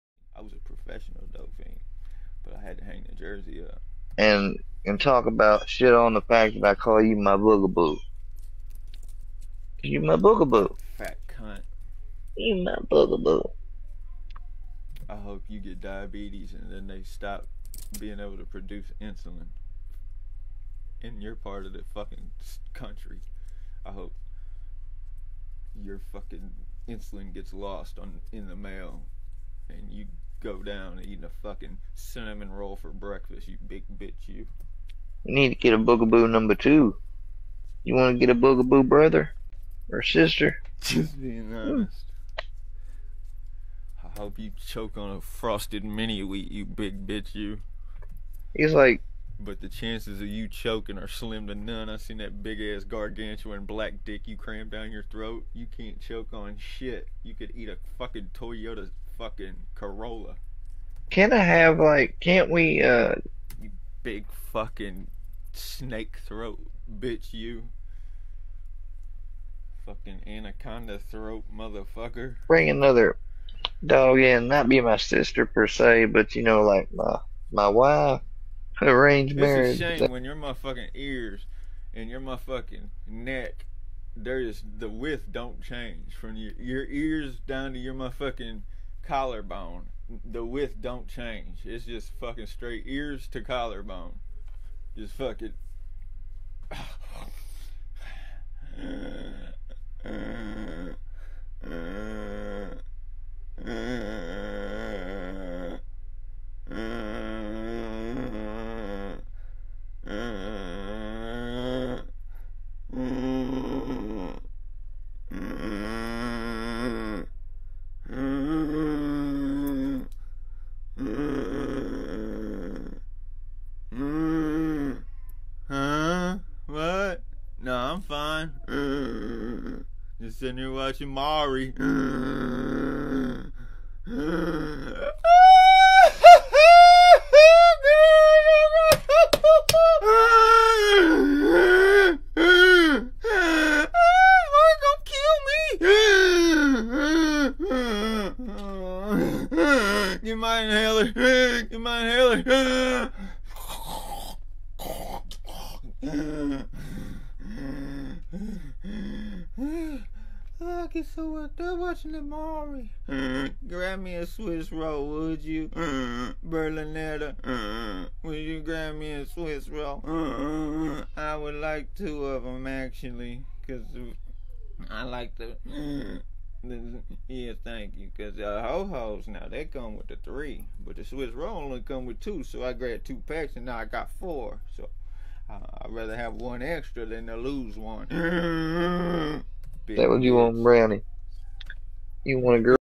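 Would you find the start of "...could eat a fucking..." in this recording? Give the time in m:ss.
0:57.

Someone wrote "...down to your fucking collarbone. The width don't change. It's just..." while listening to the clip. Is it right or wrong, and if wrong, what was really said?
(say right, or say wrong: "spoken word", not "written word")
wrong: "motherfucking", not "fucking".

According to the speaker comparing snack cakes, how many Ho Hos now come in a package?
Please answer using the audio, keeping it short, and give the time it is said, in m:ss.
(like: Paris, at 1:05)
3, at 3:00.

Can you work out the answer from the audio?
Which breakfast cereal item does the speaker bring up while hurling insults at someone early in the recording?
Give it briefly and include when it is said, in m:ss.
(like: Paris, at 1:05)
frosted mini wheat, at 0:45.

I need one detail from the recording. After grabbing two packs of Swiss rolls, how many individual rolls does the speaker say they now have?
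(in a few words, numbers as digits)
4.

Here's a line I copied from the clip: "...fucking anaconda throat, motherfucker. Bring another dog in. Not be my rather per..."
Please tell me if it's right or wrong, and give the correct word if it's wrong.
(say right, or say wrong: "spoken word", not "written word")
wrong: "sister", not "rather".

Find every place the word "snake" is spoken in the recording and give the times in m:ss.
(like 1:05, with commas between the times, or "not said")
1:05.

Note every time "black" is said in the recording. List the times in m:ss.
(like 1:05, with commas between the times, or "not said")
0:53.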